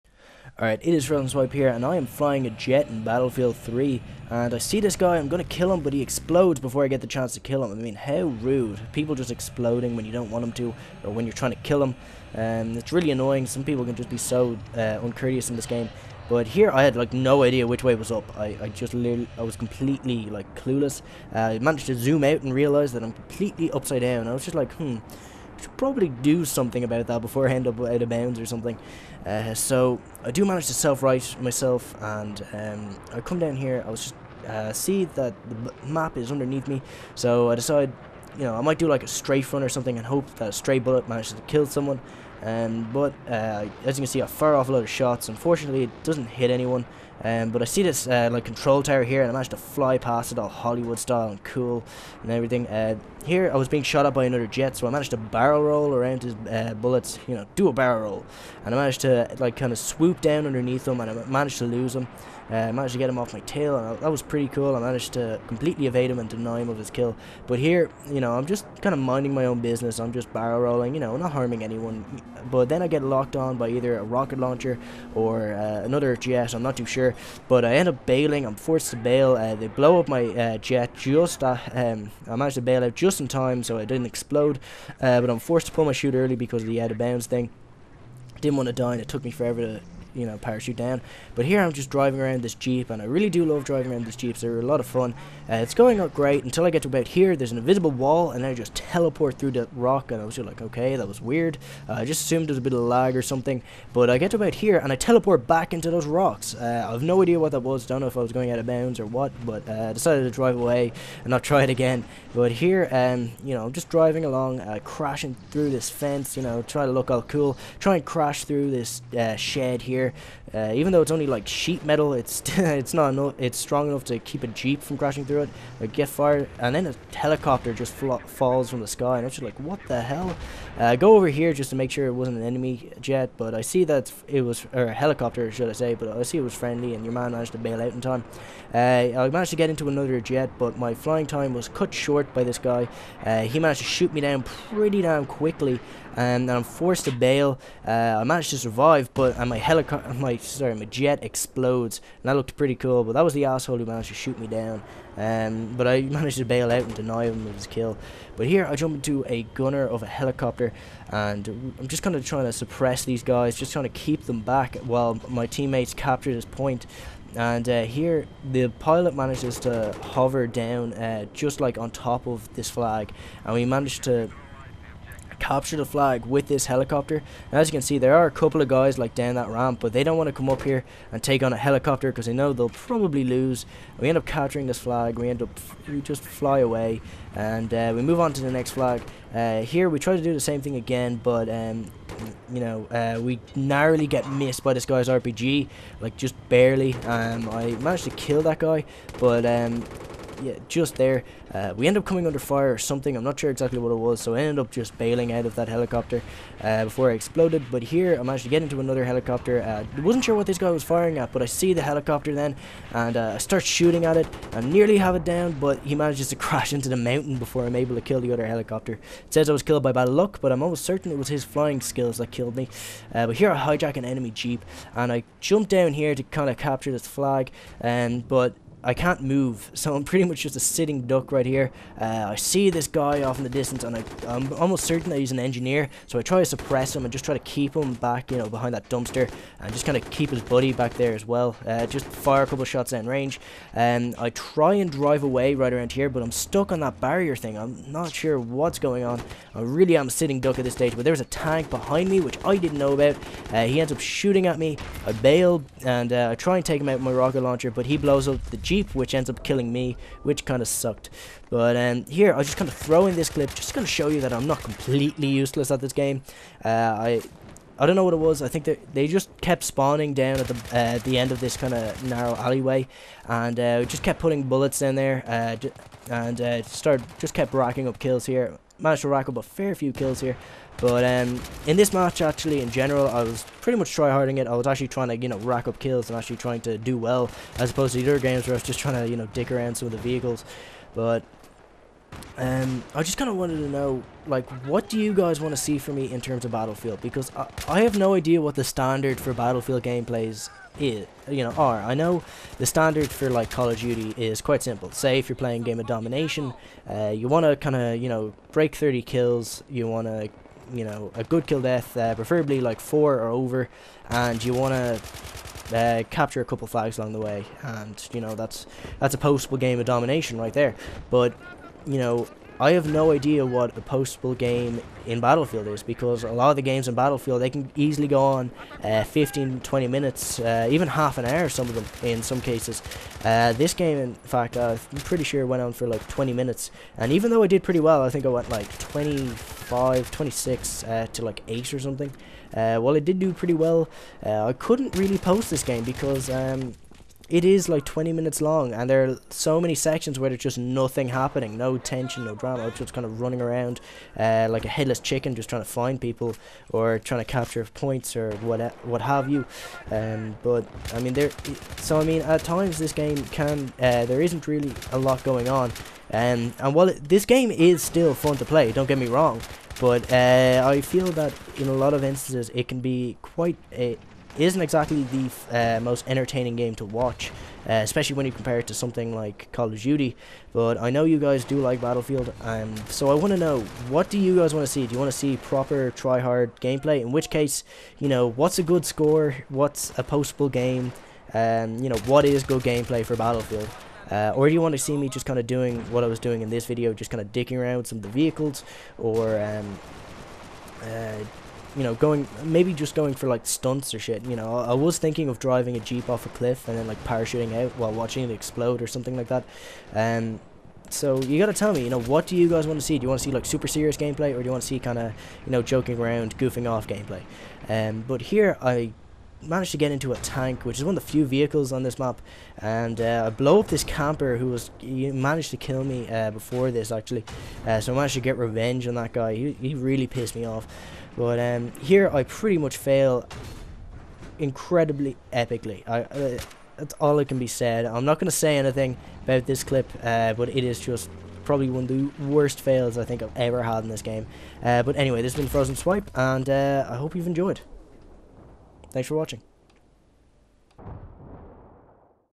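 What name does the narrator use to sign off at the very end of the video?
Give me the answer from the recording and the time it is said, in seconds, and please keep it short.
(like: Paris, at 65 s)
Frozen Swipe, at 445 s.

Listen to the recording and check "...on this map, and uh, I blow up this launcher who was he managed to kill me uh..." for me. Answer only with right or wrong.
wrong.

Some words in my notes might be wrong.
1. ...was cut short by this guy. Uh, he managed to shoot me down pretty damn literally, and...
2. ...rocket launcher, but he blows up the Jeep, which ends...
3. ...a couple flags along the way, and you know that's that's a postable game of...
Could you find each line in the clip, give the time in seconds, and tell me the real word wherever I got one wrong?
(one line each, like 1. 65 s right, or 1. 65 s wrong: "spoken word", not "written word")
1. 141 s wrong: "quickly", not "literally"
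2. 257 s right
3. 316 s right.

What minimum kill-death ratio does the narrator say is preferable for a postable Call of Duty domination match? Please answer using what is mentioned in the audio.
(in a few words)
4.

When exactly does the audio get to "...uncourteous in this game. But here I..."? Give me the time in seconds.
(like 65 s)
15 s.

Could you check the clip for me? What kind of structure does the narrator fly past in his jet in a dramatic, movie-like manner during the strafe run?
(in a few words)
control tower.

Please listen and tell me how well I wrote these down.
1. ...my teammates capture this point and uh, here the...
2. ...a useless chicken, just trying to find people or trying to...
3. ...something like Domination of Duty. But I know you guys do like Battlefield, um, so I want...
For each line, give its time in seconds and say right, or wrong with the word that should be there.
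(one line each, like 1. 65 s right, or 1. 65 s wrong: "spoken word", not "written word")
1. 165 s right
2. 354 s wrong: "headless", not "useless"
3. 378 s wrong: "Call", not "Domination".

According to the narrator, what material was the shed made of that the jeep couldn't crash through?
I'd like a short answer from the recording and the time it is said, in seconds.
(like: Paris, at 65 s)
sheet metal, at 121 s.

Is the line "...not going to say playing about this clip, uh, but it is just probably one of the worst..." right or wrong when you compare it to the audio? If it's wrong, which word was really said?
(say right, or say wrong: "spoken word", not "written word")
wrong: "anything", not "playing".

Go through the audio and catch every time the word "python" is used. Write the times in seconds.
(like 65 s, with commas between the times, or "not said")
not said.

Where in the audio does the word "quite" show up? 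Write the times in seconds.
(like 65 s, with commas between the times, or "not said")
304 s, 373 s.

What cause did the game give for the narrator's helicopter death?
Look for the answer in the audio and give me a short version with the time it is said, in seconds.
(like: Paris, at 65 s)
bad luck, at 219 s.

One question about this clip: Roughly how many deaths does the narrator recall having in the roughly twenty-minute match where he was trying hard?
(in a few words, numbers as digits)
8.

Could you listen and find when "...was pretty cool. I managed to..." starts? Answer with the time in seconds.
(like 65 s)
64 s.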